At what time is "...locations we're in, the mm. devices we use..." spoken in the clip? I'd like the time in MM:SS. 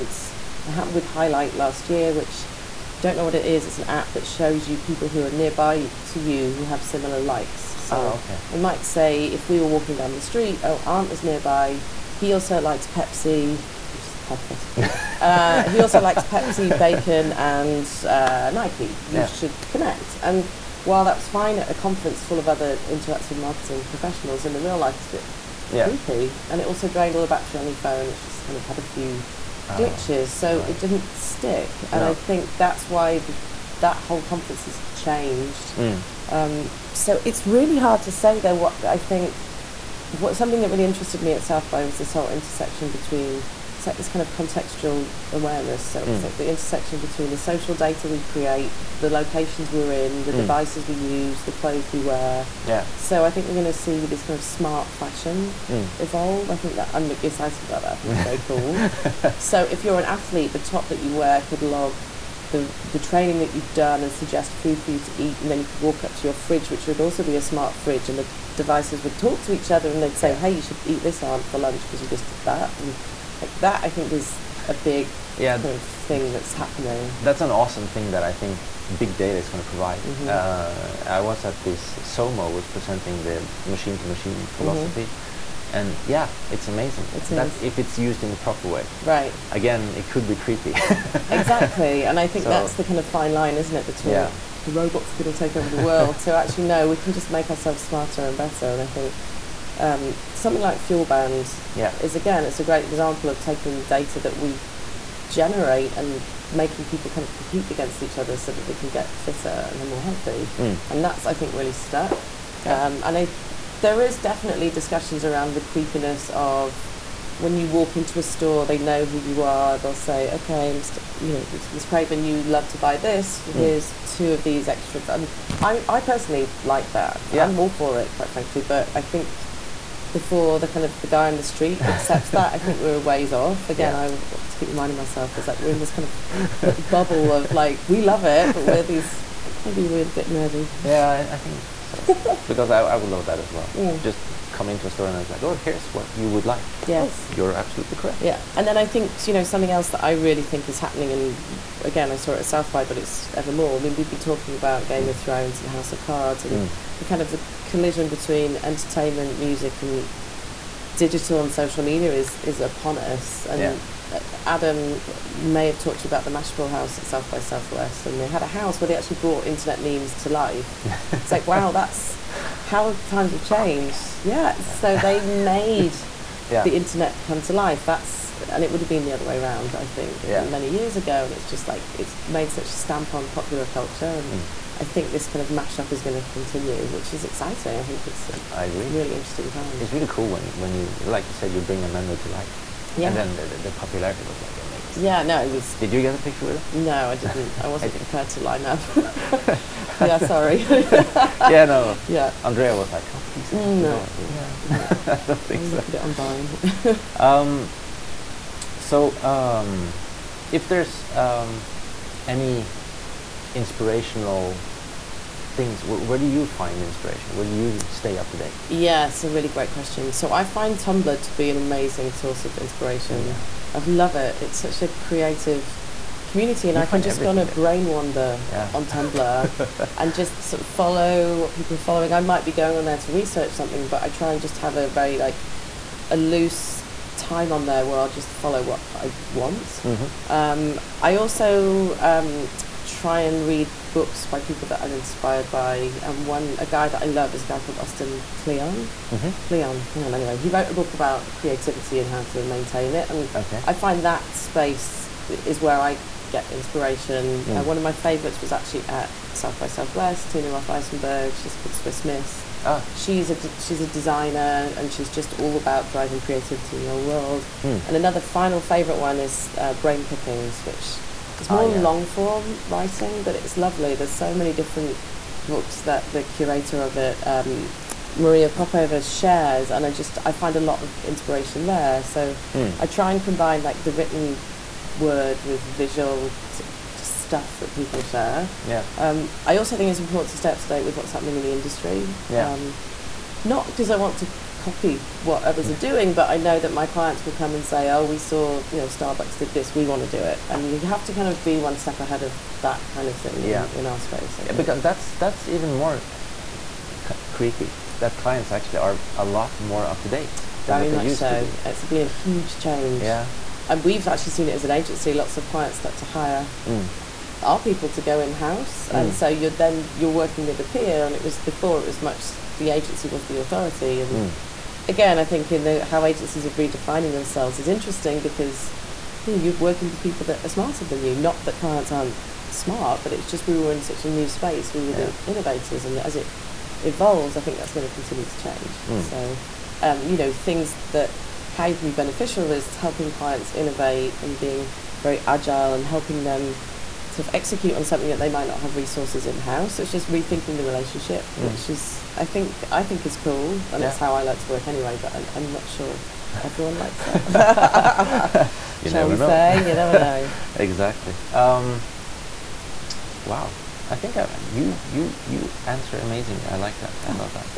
00:49.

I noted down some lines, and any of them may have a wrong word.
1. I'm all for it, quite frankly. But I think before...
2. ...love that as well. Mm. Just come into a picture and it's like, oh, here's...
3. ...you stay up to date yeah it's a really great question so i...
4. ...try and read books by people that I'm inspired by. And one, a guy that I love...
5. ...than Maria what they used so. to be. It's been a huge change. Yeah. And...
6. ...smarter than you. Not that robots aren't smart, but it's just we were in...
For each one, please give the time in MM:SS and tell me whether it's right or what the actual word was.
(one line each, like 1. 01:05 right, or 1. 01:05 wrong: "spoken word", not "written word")
1. 02:07 right
2. 02:23 wrong: "store", not "picture"
3. 03:37 right
4. 04:02 right
5. 05:10 wrong: "Very", not "Maria"
6. 05:30 wrong: "clients", not "robots".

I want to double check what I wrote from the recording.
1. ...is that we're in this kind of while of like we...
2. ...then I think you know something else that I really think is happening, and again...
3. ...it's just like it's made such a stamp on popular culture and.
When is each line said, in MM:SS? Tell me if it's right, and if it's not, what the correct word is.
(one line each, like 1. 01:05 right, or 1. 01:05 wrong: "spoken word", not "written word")
1. 02:15 wrong: "bubble", not "while"
2. 02:28 right
3. 03:01 right.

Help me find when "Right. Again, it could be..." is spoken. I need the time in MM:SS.
01:29.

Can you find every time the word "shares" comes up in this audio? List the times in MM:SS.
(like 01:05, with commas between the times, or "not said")
04:39, 04:48.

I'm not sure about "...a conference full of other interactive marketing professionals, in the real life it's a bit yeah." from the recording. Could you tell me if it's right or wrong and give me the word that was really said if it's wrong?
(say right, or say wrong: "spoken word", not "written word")
right.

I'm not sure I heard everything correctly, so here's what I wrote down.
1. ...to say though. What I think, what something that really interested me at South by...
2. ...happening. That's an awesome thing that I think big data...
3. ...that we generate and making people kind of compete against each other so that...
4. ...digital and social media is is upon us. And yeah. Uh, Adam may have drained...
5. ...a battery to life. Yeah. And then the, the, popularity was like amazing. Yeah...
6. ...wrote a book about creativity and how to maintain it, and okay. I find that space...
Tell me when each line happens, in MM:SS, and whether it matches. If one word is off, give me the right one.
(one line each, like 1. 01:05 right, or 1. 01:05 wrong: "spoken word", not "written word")
1. 00:38 right
2. 01:16 right
3. 01:44 right
4. 02:40 wrong: "talked", not "drained"
5. 03:11 wrong: "memory", not "battery"
6. 04:10 right.